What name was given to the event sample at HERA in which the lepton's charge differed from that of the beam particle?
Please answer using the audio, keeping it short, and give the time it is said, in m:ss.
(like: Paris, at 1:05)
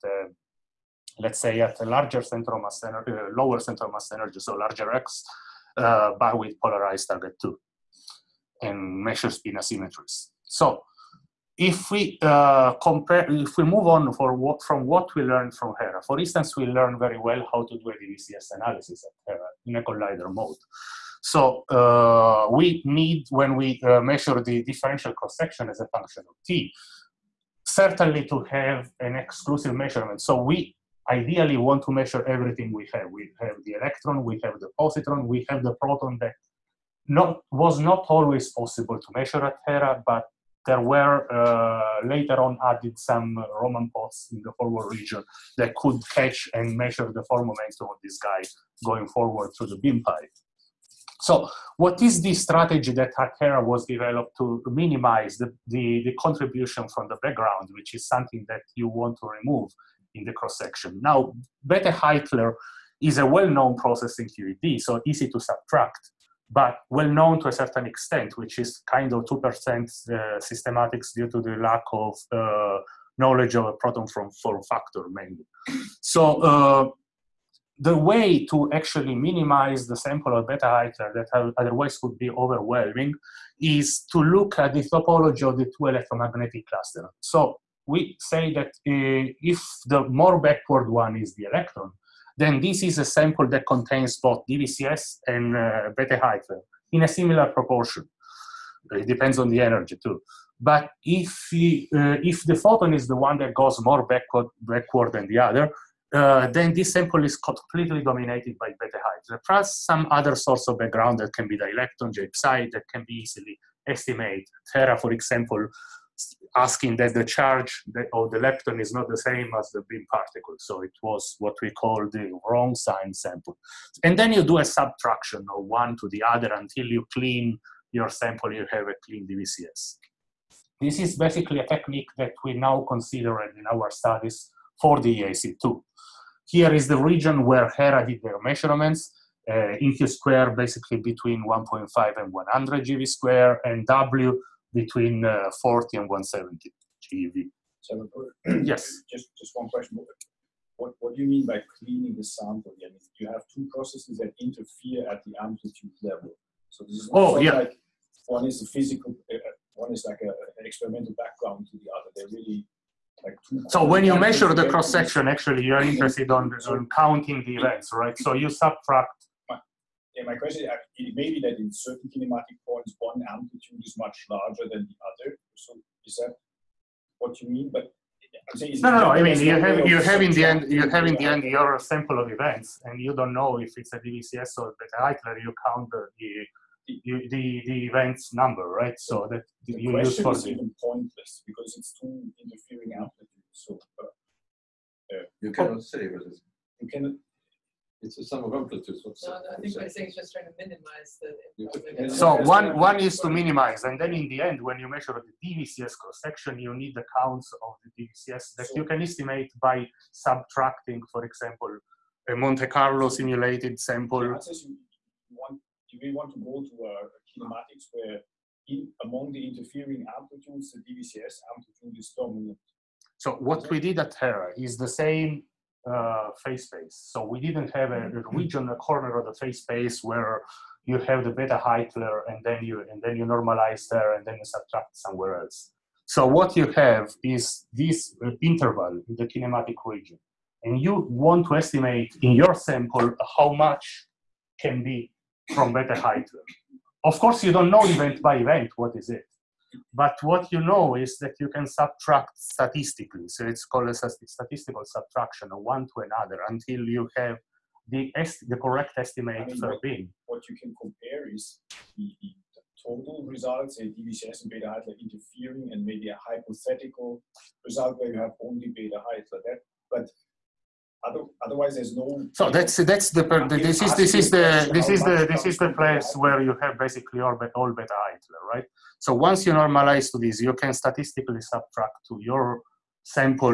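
wrong sign sample, at 2:02.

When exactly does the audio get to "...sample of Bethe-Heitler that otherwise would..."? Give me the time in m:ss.
1:19.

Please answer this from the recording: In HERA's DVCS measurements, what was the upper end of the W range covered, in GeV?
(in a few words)
170 GeV.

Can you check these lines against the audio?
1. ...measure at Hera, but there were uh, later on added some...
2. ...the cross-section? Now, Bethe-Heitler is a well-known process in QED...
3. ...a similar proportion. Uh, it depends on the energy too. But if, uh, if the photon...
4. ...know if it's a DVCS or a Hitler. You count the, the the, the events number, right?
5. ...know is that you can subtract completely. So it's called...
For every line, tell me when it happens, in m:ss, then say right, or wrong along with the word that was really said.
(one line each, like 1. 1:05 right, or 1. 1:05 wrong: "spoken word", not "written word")
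1. 0:39 right
2. 1:00 right
3. 1:37 right
4. 3:03 wrong: "Eichler", not "Hitler"
5. 4:10 wrong: "statistically", not "completely".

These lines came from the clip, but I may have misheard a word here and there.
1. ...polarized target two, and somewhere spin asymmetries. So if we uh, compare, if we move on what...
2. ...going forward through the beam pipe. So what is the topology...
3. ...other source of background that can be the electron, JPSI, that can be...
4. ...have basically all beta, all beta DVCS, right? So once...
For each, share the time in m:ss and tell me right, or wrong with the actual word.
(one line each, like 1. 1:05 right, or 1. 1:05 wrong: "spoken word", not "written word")
1. 0:06 wrong: "measure", not "somewhere"
2. 0:48 wrong: "strategy", not "topology"
3. 1:50 right
4. 4:36 wrong: "Hitler", not "DVCS".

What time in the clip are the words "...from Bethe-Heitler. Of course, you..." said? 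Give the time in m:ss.
4:05.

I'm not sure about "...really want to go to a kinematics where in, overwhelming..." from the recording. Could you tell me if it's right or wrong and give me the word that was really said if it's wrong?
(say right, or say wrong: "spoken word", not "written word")
wrong: "among", not "overwhelming".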